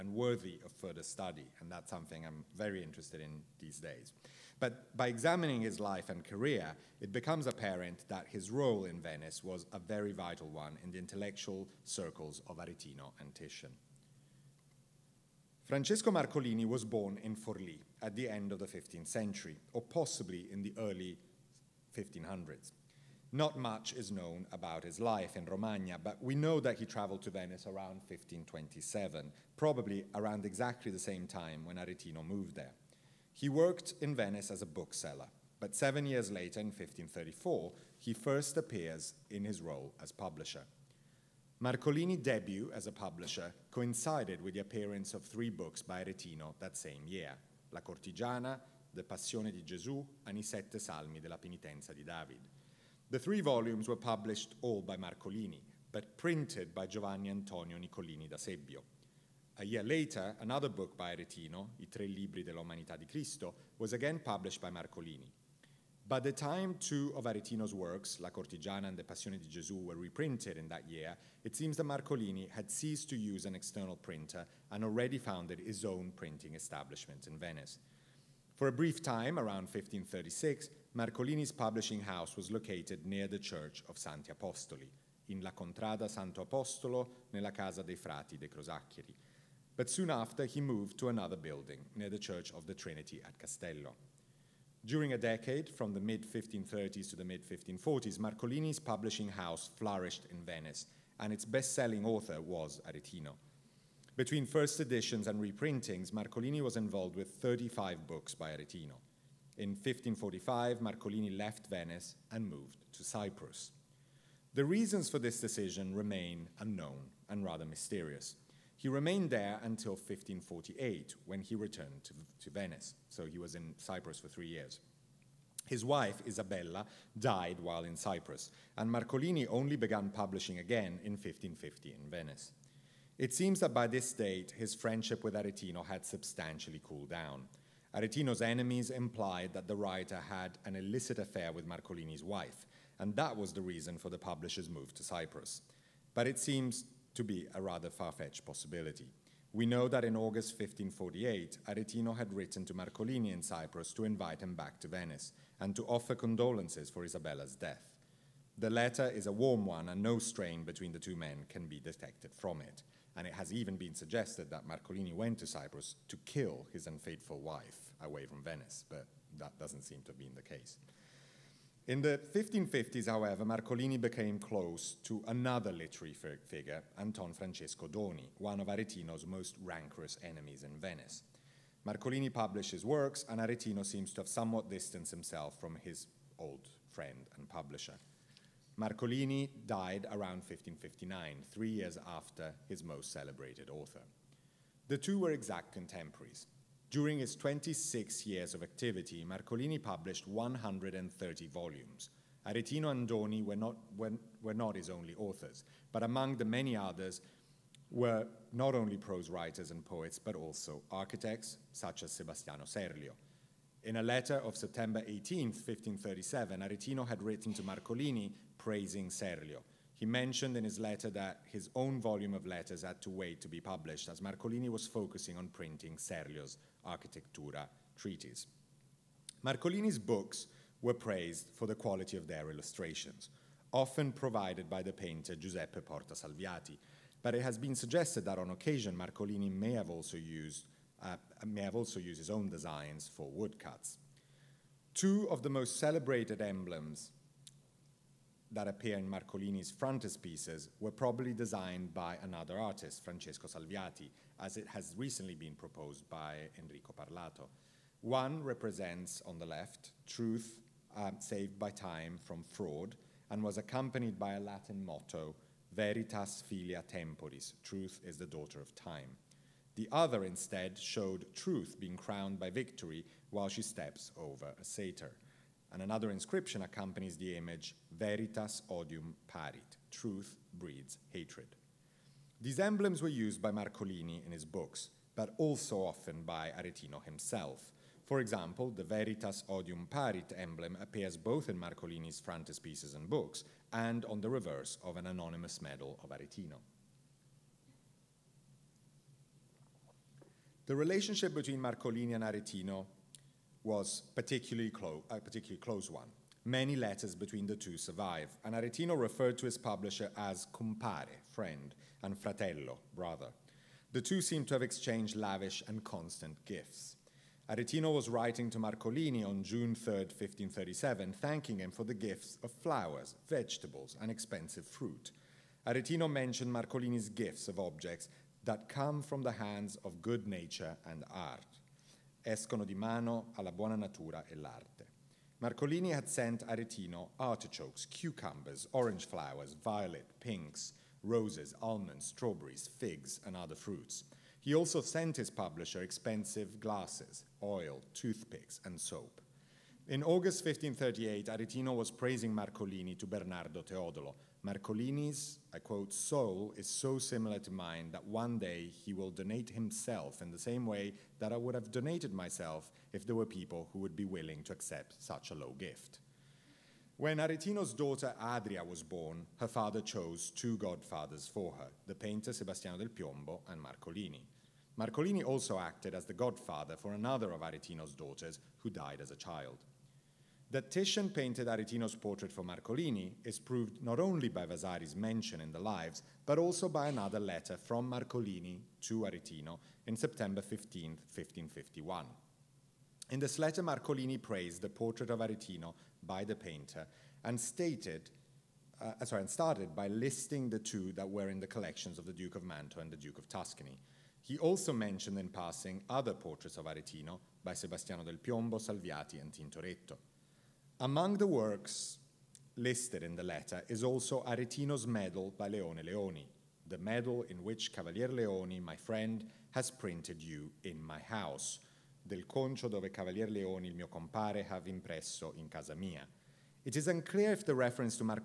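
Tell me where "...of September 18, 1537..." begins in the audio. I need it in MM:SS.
03:34.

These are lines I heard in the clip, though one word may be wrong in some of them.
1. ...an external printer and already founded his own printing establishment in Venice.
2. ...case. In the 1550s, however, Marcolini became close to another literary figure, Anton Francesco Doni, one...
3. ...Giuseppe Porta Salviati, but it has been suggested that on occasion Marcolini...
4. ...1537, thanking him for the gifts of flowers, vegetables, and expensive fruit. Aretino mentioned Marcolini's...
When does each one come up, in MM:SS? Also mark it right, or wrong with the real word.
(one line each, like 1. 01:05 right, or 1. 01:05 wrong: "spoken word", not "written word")
1. 01:13 right
2. 02:50 right
3. 03:55 right
4. 05:19 right.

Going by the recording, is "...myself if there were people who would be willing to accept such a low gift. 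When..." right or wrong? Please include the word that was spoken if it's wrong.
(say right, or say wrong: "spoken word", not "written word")
right.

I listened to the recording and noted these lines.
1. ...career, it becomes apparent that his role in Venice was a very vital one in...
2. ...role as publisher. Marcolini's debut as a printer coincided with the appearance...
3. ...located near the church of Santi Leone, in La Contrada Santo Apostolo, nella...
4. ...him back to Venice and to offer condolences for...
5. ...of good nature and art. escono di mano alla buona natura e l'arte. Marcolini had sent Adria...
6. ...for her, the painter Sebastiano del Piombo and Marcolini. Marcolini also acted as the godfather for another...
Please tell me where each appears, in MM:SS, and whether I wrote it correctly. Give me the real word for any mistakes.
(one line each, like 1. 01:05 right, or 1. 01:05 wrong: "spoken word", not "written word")
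1. 00:06 right
2. 00:39 wrong: "publisher", not "printer"
3. 01:22 wrong: "Apostoli", not "Leone"
4. 02:34 right
5. 05:29 wrong: "Aretino", not "Adria"
6. 06:11 right.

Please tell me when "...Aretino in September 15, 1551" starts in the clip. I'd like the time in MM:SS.
06:29.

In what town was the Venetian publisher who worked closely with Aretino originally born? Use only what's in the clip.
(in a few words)
Forlì.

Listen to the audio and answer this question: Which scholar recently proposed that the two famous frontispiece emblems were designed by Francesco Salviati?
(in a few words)
Enrico Parlato.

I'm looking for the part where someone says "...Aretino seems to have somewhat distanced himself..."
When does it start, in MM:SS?
03:03.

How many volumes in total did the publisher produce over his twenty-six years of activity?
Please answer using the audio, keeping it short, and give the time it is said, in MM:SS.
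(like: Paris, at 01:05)
130, at 03:20.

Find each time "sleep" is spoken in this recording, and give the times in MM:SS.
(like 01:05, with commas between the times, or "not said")
not said.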